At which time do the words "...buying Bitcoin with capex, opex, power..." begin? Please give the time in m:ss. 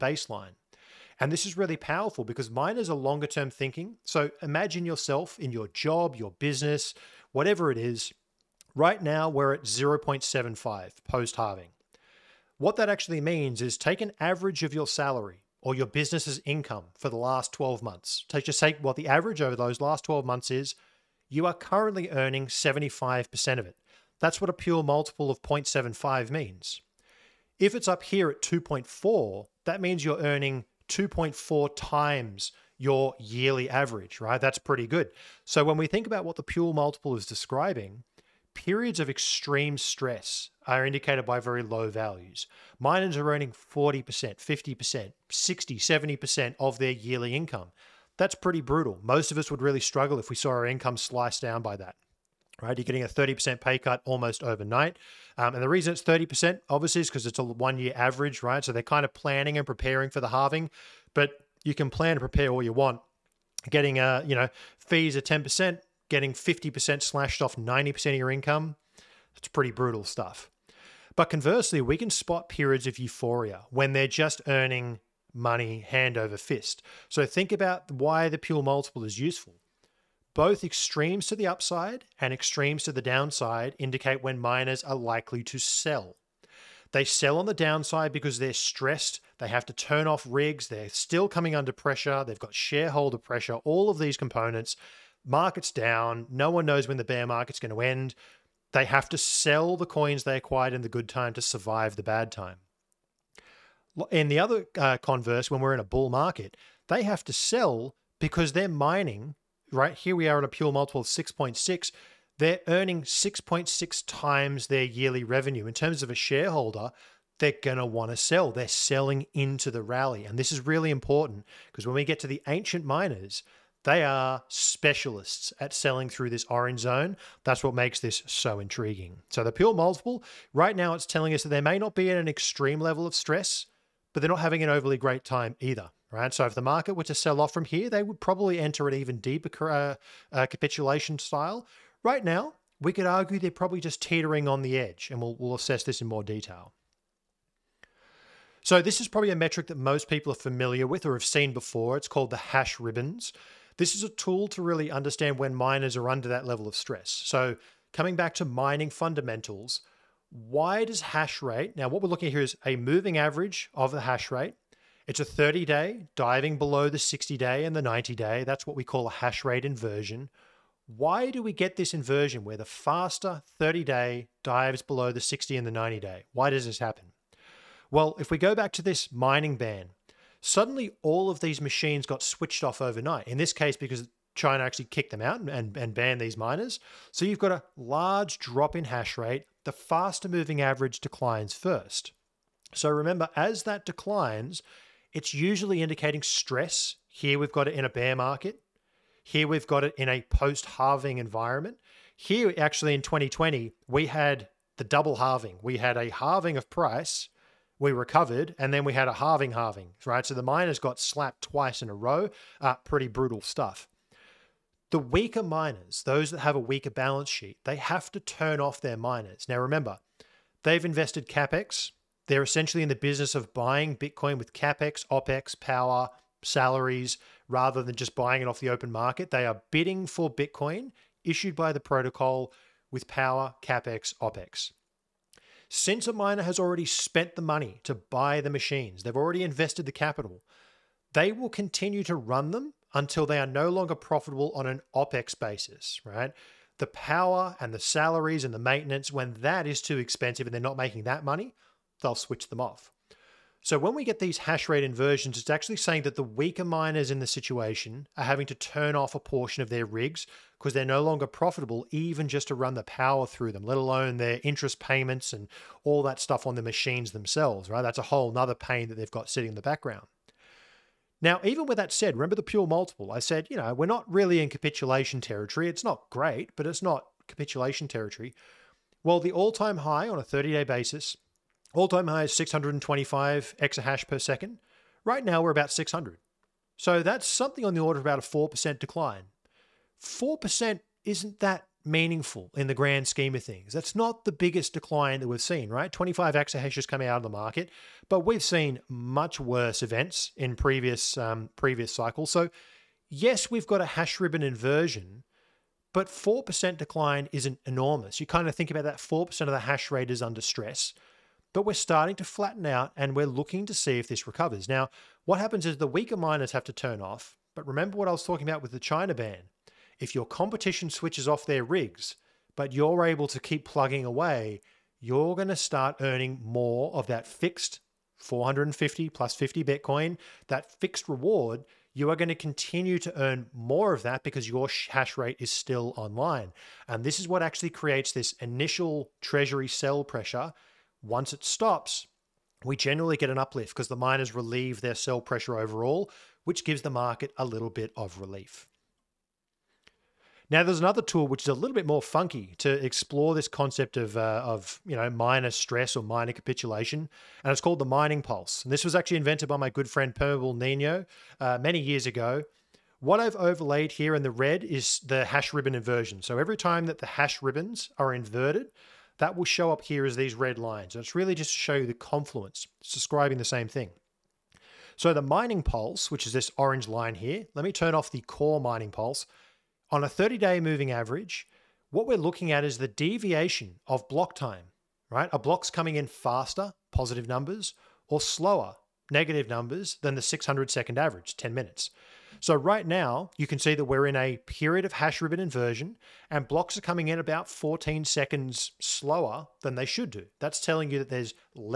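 3:43.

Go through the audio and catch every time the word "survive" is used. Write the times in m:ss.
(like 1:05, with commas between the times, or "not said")
1:41.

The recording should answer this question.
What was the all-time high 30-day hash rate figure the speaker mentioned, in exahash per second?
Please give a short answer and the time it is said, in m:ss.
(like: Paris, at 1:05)
625, at 4:42.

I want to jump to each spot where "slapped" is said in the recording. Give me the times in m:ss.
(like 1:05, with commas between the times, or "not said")
3:31.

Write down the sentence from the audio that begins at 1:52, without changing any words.
They're earning 6.6 times their yearly revenue.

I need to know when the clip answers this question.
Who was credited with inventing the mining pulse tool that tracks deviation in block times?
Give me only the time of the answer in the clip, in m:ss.
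6:00.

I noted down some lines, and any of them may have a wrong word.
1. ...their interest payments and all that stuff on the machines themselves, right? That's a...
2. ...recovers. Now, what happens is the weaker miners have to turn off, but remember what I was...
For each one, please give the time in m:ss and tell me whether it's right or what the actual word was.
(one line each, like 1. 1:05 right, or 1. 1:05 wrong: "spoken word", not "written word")
1. 4:24 right
2. 5:14 right.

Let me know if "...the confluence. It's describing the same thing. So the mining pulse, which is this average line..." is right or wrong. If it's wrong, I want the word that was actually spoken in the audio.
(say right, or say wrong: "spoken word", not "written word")
wrong: "orange", not "average".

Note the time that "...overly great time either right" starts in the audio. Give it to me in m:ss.
2:14.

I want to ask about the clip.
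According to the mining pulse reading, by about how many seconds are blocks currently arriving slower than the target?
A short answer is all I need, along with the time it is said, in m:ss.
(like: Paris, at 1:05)
14 seconds, at 6:37.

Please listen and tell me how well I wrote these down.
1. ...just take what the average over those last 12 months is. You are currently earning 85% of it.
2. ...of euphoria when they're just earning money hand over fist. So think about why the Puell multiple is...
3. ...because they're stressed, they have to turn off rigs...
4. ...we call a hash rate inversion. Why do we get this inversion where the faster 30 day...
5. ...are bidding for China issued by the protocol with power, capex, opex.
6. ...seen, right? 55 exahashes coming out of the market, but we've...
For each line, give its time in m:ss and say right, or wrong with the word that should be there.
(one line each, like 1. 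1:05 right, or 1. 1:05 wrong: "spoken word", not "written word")
1. 0:18 wrong: "75", not "85"
2. 1:12 right
3. 1:28 right
4. 2:48 right
5. 3:49 wrong: "Bitcoin", not "China"
6. 4:55 wrong: "25", not "55".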